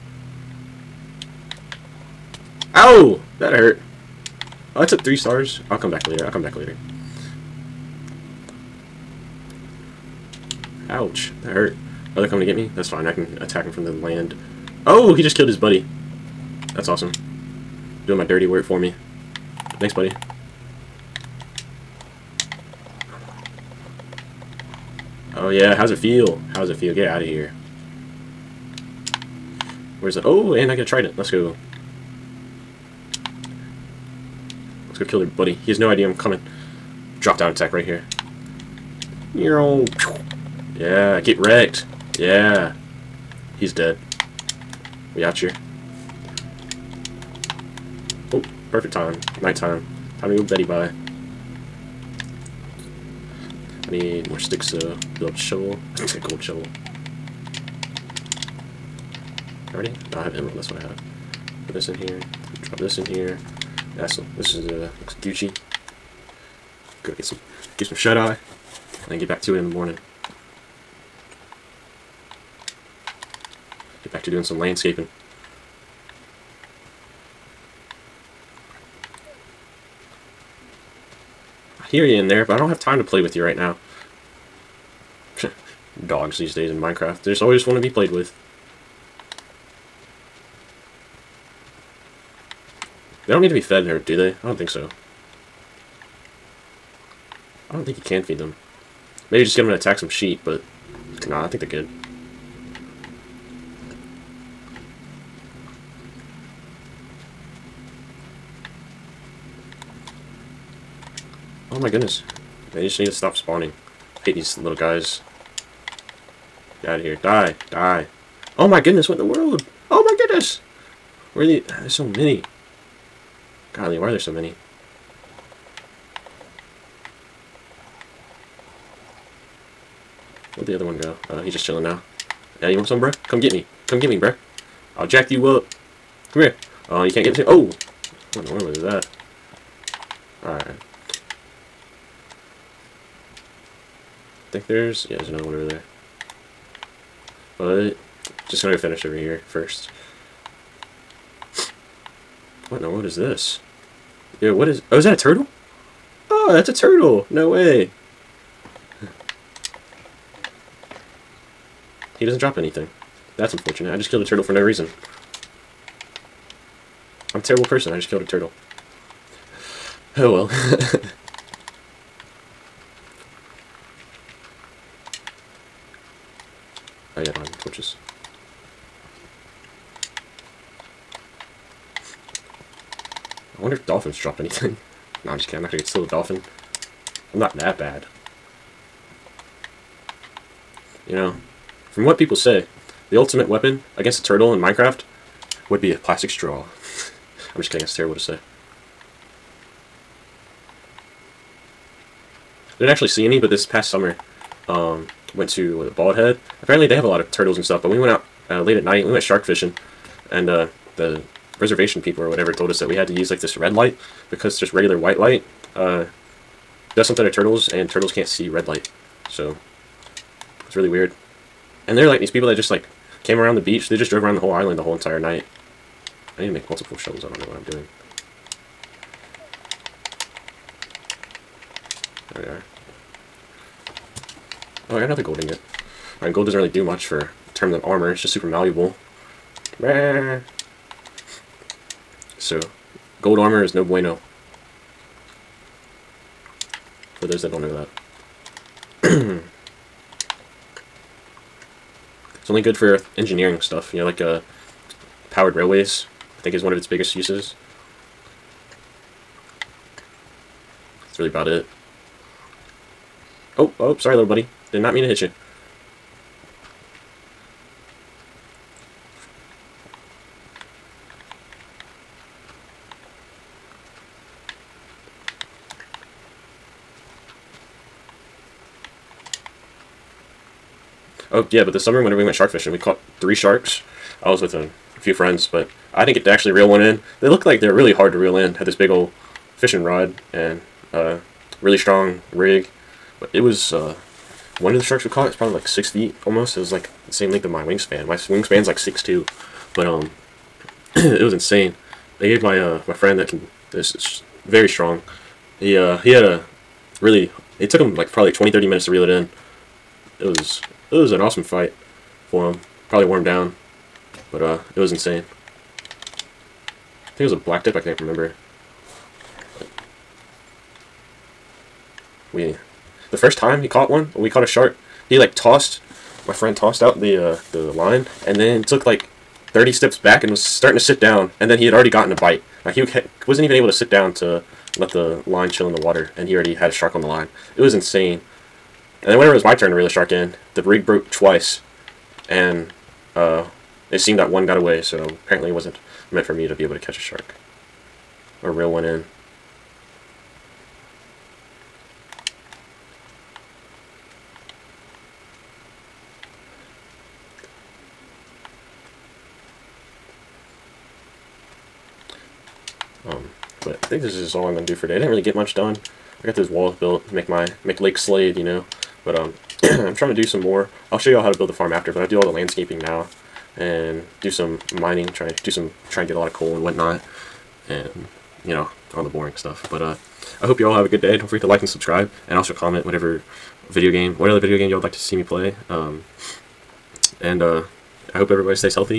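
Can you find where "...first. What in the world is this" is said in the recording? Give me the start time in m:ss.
2:29.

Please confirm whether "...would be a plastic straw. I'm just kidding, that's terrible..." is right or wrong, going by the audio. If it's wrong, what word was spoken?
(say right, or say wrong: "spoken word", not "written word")
right.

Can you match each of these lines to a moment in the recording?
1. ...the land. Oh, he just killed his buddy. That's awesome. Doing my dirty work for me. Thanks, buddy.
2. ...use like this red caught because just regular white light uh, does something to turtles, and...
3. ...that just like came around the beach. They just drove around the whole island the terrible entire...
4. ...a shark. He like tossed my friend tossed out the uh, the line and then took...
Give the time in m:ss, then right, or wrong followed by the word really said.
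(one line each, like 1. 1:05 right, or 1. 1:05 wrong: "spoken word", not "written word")
1. 0:13 right
2. 3:33 wrong: "light", not "caught"
3. 3:42 wrong: "whole", not "terrible"
4. 5:24 right.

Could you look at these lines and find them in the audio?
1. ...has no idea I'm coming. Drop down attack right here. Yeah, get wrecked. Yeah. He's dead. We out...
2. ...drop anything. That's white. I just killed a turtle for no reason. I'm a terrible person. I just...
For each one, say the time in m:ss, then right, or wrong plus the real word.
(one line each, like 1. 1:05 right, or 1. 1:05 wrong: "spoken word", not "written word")
1. 0:35 right
2. 2:42 wrong: "unfortunate", not "white".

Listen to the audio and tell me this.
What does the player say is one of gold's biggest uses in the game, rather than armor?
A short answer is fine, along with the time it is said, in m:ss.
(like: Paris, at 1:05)
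powered railways, at 4:15.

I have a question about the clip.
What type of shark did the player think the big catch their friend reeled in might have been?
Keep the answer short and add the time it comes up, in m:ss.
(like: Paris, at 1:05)
black tip, at 5:17.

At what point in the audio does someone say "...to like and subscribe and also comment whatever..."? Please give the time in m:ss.
6:21.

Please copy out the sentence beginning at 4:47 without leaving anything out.
They looked like they're really hard to reel in.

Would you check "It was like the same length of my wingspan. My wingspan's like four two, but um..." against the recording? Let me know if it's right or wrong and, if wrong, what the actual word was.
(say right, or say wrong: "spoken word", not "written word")
wrong: "six", not "four".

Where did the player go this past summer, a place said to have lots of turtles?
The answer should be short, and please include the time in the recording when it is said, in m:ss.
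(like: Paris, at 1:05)
Bald Head, at 3:25.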